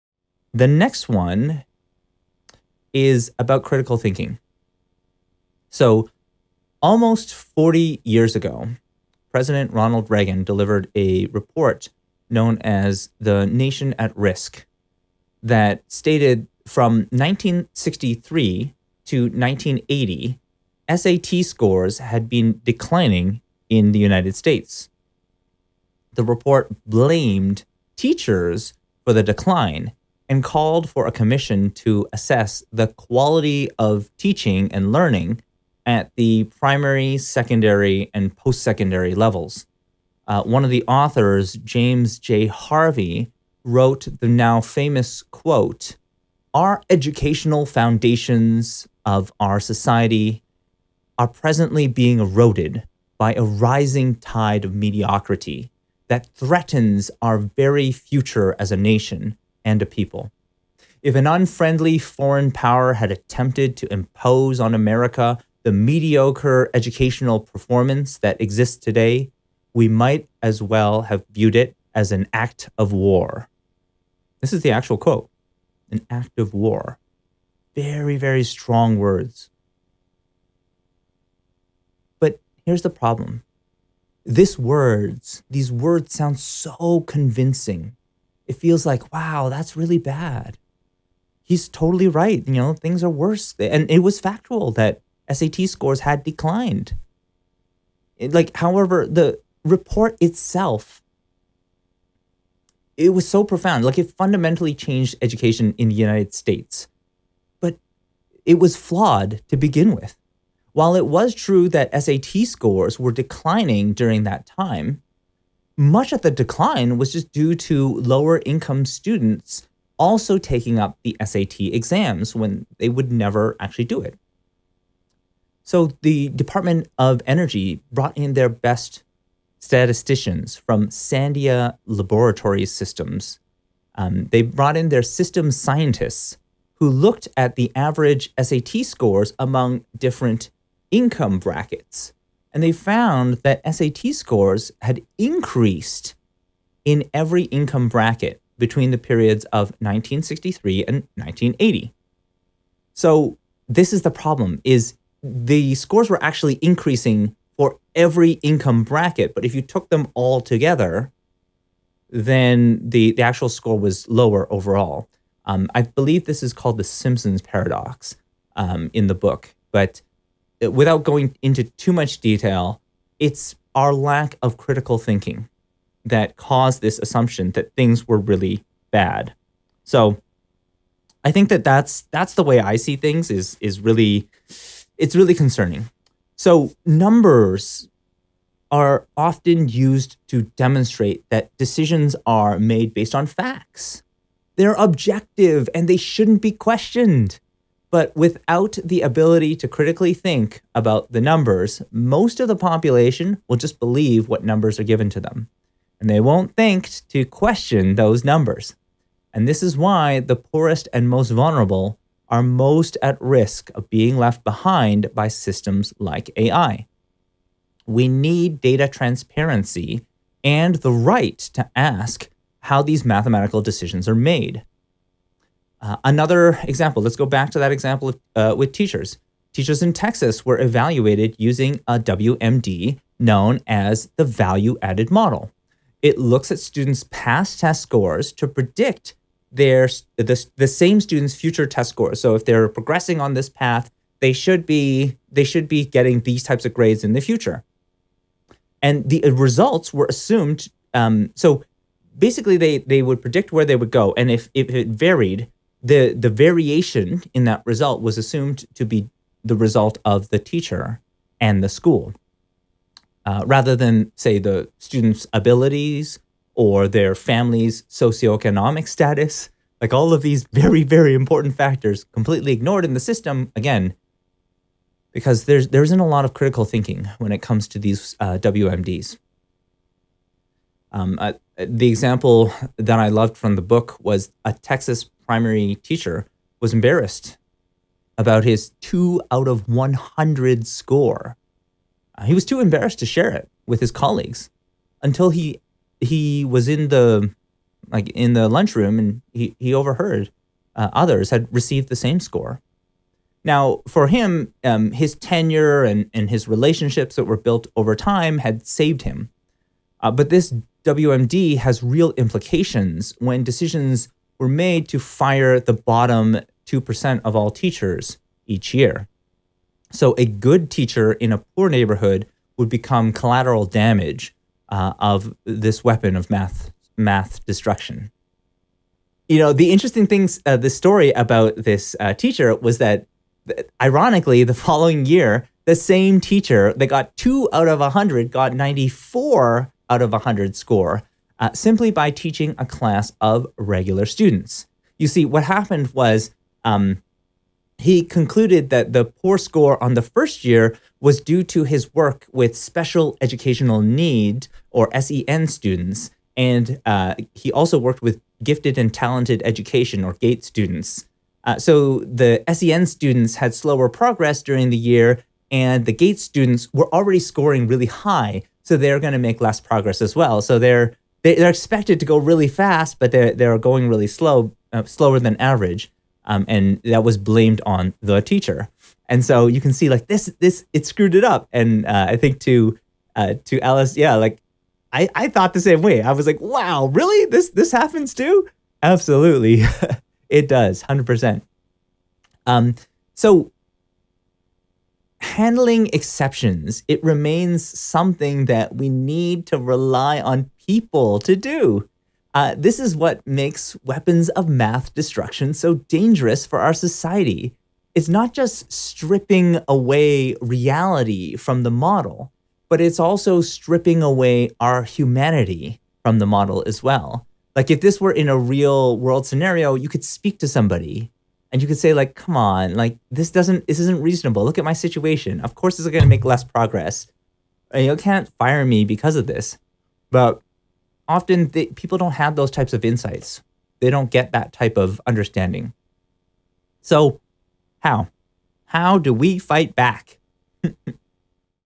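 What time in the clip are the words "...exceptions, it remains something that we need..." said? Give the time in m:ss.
6:35.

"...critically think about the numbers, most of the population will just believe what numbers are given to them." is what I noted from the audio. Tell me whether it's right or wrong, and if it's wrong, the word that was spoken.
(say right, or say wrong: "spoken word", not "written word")
right.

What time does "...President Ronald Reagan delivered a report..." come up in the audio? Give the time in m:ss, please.
0:09.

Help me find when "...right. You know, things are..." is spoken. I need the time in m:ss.
1:32.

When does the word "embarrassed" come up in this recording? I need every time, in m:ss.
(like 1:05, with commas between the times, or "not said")
4:46, 4:52.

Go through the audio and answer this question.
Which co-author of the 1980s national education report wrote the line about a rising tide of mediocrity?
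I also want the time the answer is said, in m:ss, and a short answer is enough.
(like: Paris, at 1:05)
James J. Harvey, at 0:41.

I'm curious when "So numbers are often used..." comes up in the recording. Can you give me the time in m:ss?
3:06.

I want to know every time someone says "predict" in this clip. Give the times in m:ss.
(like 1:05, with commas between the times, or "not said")
3:58, 4:13.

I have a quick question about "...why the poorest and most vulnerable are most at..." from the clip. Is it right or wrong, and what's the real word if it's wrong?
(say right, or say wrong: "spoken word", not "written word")
right.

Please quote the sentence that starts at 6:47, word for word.
It's not just stripping away reality from the model, but it's also stripping away our humanity from the model as well.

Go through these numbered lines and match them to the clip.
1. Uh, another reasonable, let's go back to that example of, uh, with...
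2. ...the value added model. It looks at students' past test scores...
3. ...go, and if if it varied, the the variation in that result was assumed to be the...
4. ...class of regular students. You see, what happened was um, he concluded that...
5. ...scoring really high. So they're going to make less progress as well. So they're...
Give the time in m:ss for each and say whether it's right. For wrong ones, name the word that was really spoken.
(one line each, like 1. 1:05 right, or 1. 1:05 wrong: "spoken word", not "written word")
1. 3:45 wrong: "example", not "reasonable"
2. 3:54 right
3. 4:13 right
4. 5:42 right
5. 6:07 right.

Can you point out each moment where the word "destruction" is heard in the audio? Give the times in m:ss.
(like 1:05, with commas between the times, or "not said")
5:27, 6:44.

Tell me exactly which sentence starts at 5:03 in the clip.
Now, for him, um, his tenure and, and his relationships that were built over time had saved him.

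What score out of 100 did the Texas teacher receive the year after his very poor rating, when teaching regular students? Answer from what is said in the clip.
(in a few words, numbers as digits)
94.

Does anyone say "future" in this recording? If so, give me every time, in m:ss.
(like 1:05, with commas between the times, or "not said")
0:57, 4:01, 4:07.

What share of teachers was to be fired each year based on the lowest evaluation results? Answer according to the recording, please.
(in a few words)
bottom 2%.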